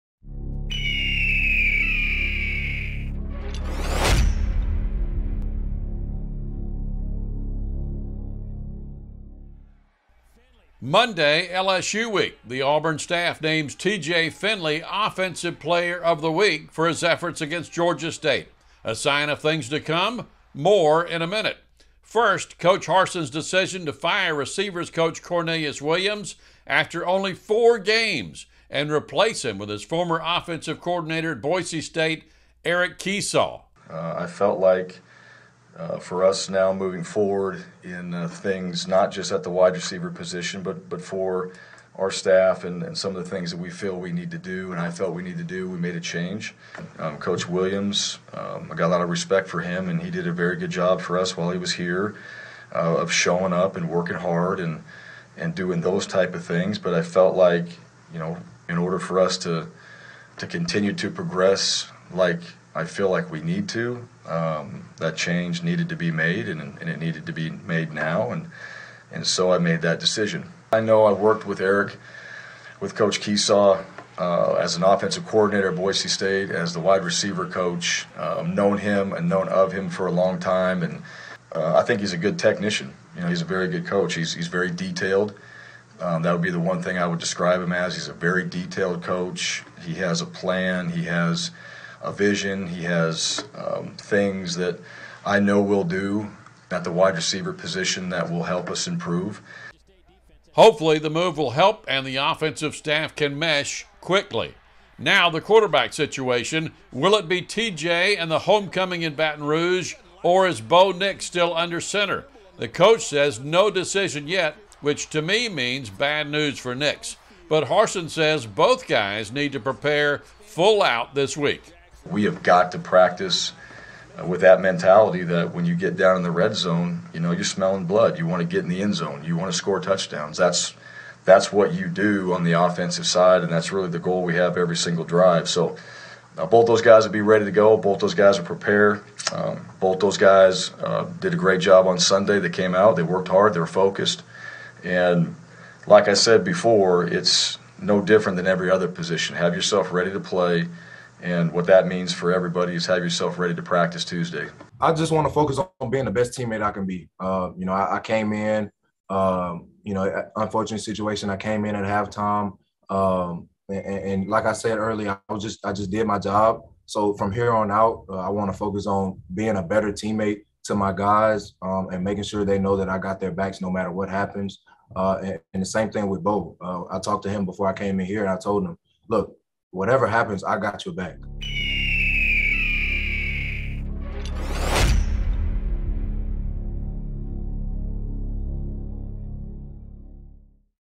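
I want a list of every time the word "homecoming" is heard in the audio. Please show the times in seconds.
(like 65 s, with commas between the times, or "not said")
108 s.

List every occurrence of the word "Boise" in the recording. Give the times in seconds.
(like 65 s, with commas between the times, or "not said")
31 s, 75 s.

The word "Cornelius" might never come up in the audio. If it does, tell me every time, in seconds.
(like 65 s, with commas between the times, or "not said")
25 s.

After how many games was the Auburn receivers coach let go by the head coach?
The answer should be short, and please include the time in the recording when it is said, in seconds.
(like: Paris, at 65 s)
4, at 27 s.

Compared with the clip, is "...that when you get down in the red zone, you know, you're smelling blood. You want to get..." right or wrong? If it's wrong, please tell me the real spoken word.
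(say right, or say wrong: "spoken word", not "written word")
right.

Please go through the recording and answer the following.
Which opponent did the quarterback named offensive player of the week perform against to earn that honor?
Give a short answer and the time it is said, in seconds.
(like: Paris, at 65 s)
Georgia State, at 17 s.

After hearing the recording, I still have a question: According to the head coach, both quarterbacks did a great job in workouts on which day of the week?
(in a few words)
Sunday.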